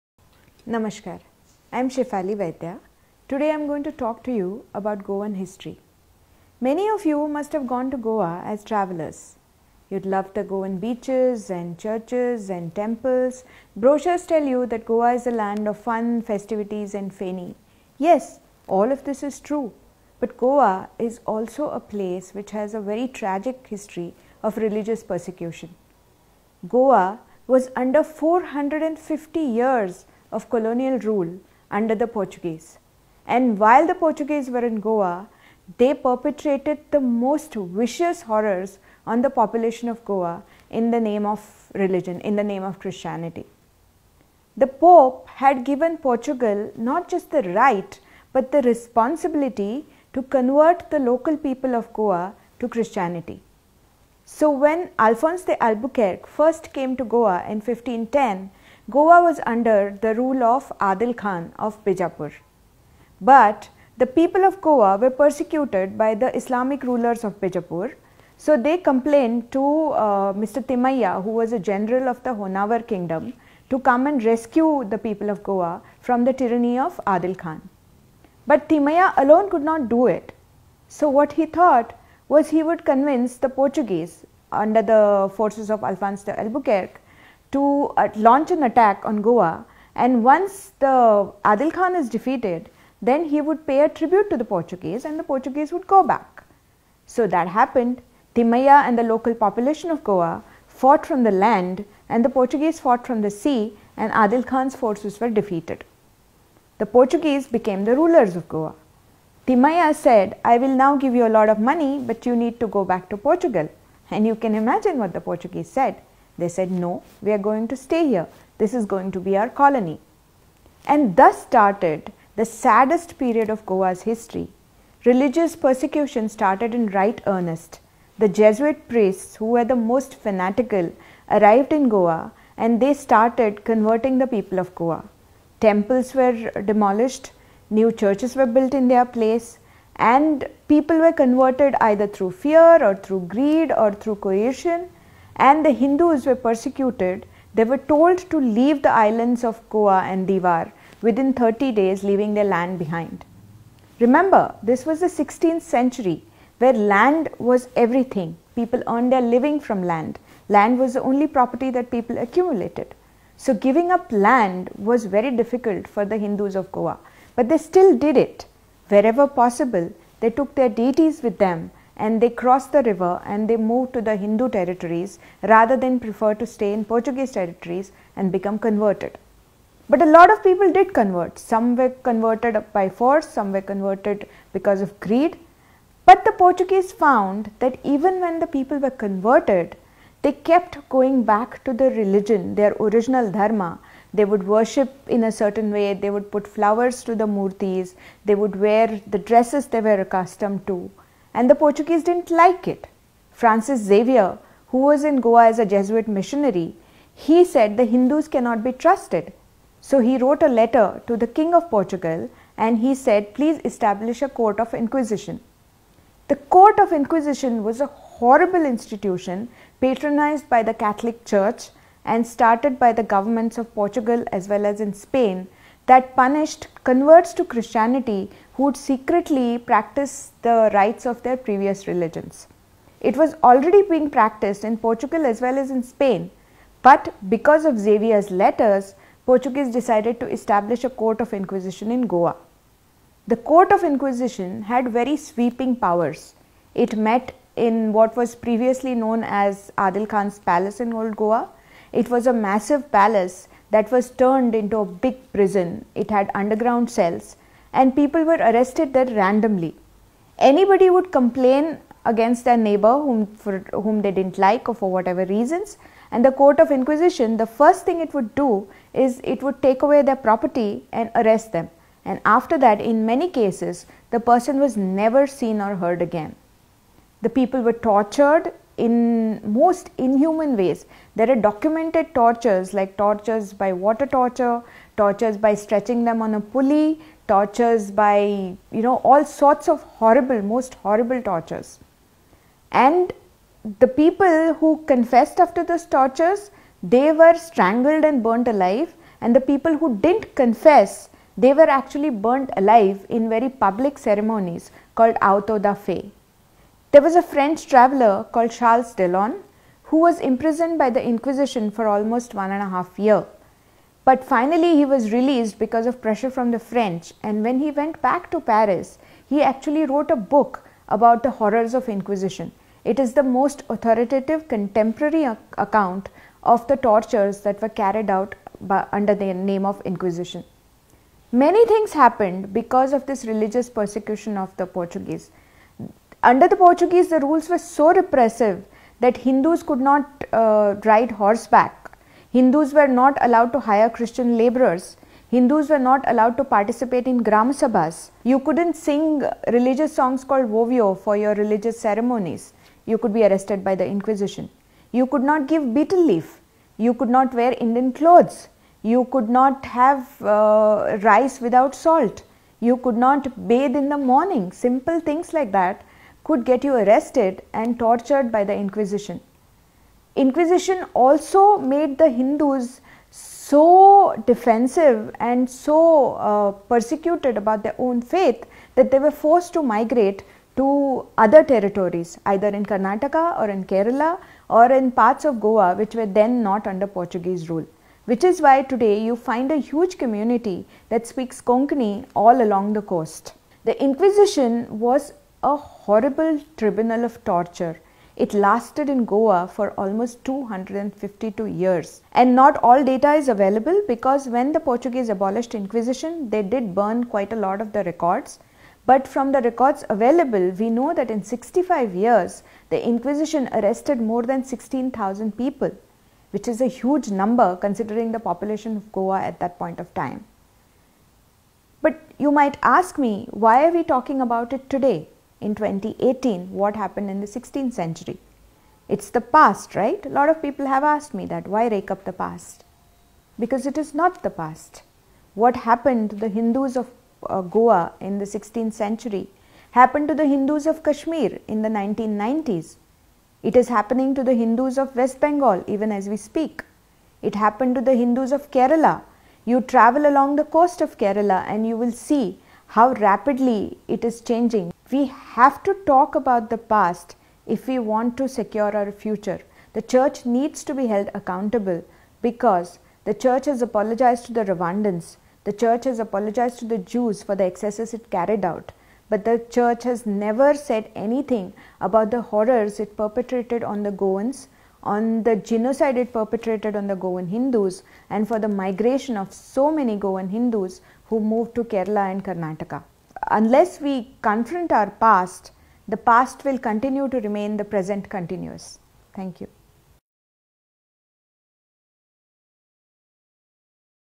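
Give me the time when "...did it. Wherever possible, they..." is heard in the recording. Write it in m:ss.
2:47.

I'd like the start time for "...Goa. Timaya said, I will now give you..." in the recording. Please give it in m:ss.
1:48.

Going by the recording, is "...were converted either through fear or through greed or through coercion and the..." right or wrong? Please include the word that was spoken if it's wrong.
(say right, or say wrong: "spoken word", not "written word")
right.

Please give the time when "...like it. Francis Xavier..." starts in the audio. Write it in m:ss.
3:22.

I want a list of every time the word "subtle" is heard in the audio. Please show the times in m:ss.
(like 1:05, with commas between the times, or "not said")
not said.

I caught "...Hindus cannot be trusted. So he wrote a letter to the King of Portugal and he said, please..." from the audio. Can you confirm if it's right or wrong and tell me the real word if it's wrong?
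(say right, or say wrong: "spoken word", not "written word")
right.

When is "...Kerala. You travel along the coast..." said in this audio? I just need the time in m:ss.
7:28.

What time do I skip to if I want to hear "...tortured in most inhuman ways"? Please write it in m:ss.
4:37.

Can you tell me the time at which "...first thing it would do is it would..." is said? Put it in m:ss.
4:27.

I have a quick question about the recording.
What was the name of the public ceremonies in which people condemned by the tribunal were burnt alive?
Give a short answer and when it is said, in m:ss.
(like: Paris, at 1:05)
auto da fe, at 5:05.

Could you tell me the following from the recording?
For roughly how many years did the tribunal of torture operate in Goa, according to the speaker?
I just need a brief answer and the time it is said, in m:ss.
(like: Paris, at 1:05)
252, at 6:40.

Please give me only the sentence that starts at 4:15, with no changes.
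It had underground cells, and people were arrested there randomly.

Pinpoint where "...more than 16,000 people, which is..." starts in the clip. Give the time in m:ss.
6:53.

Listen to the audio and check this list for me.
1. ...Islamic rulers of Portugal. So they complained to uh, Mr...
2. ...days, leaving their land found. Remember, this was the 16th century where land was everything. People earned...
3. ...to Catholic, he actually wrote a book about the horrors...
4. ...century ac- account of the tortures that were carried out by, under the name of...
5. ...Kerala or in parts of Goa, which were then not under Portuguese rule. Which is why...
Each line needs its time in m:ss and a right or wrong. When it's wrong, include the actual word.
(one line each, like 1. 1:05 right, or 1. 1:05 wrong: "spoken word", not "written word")
1. 1:06 wrong: "Bijapur", not "Portugal"
2. 2:31 wrong: "behind", not "found"
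3. 5:18 wrong: "Paris", not "Catholic"
4. 5:24 wrong: "contemporary", not "century"
5. 6:23 right.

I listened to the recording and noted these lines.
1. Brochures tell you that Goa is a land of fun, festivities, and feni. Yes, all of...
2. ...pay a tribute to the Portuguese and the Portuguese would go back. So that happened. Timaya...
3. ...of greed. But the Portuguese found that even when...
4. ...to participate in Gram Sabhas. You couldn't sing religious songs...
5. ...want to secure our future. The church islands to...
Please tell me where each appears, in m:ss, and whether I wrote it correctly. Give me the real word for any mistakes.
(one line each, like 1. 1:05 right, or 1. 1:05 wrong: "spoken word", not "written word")
1. 0:13 right
2. 1:33 right
3. 3:04 right
4. 5:46 right
5. 7:37 wrong: "needs", not "islands".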